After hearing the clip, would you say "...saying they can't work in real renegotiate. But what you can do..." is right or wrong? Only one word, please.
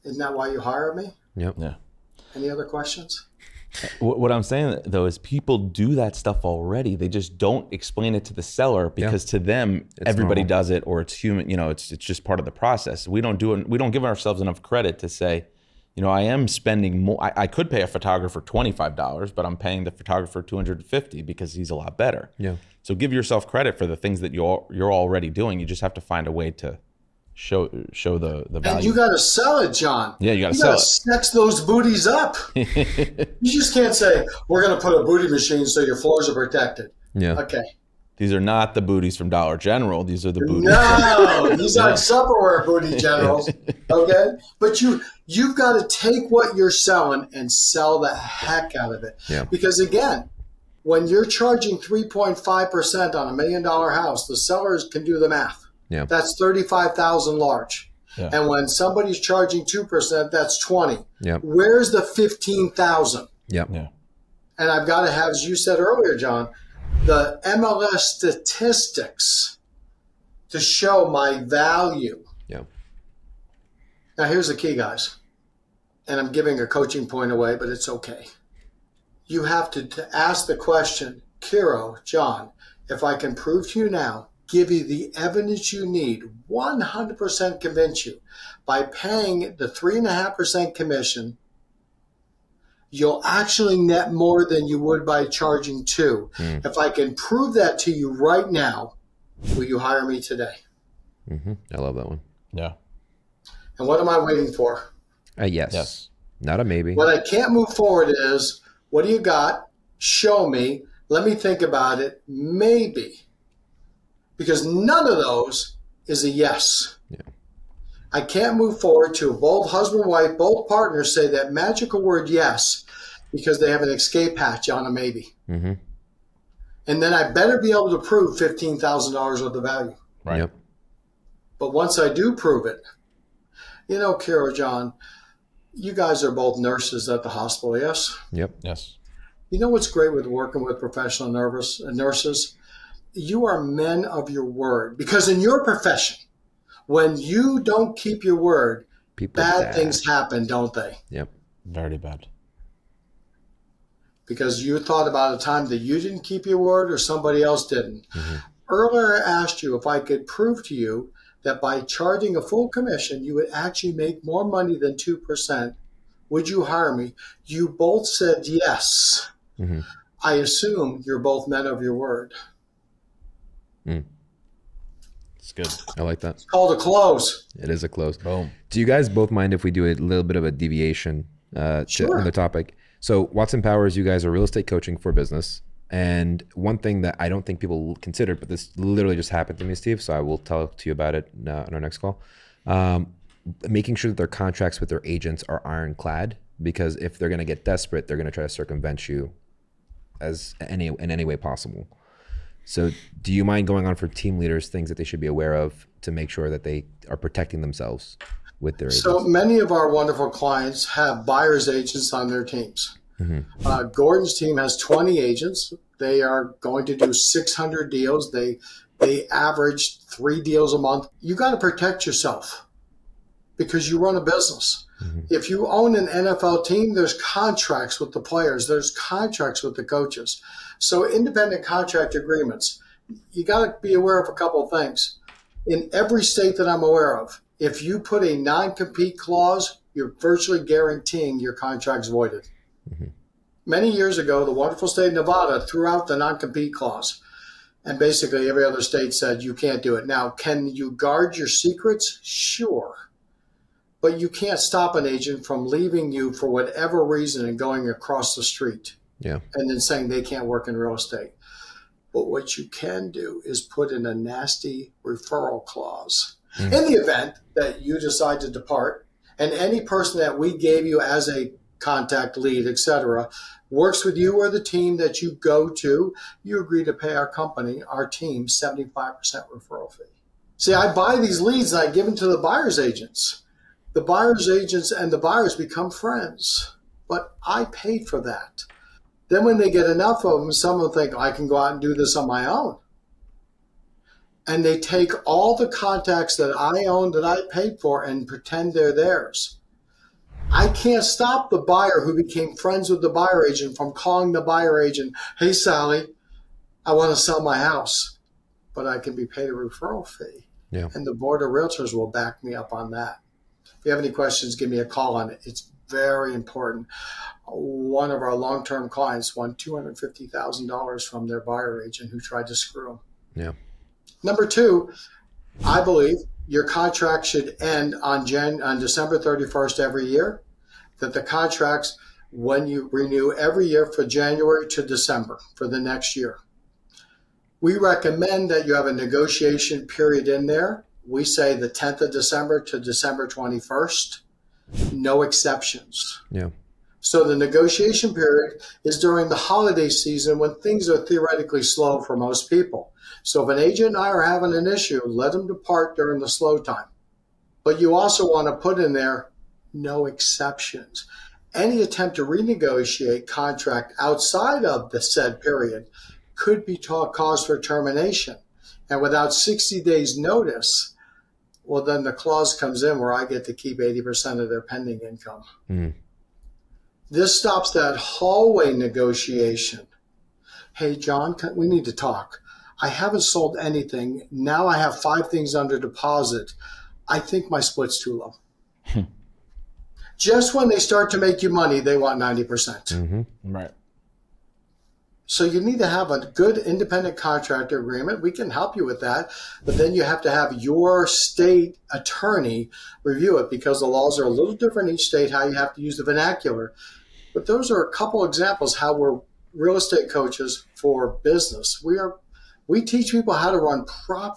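wrong.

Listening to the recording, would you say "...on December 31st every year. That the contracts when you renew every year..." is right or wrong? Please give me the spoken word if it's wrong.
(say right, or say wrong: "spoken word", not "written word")
right.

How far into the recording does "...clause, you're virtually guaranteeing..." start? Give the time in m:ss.
3:59.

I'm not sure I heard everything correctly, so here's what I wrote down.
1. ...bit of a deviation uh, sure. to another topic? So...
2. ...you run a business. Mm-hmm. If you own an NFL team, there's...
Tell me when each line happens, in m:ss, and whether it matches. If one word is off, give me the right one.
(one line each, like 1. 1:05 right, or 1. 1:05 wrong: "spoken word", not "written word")
1. 3:00 right
2. 3:43 right.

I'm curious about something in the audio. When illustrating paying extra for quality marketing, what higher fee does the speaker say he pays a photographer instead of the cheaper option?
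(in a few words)
$250.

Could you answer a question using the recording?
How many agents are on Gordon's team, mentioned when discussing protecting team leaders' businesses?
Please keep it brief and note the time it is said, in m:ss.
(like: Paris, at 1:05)
20, at 3:34.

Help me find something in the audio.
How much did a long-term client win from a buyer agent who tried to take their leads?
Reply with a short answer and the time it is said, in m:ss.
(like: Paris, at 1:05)
$250,000, at 5:19.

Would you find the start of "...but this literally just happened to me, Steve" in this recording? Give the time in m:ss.
3:08.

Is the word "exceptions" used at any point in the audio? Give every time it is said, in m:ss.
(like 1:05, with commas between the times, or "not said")
5:45, 6:00.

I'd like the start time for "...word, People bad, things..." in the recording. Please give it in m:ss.
2:28.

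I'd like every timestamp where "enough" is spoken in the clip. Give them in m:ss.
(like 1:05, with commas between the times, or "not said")
0:14, 4:49.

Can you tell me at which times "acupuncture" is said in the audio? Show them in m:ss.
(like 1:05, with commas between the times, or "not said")
not said.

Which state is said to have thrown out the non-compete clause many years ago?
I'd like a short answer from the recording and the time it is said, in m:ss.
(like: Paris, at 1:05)
Nevada, at 4:05.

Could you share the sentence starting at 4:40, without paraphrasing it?
See, I buy these leads and I give them to the buyer's agents.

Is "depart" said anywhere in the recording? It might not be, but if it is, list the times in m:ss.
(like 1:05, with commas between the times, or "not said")
4:28, 5:55.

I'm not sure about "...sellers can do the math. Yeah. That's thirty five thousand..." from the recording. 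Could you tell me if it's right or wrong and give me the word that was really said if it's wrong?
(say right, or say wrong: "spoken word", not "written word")
right.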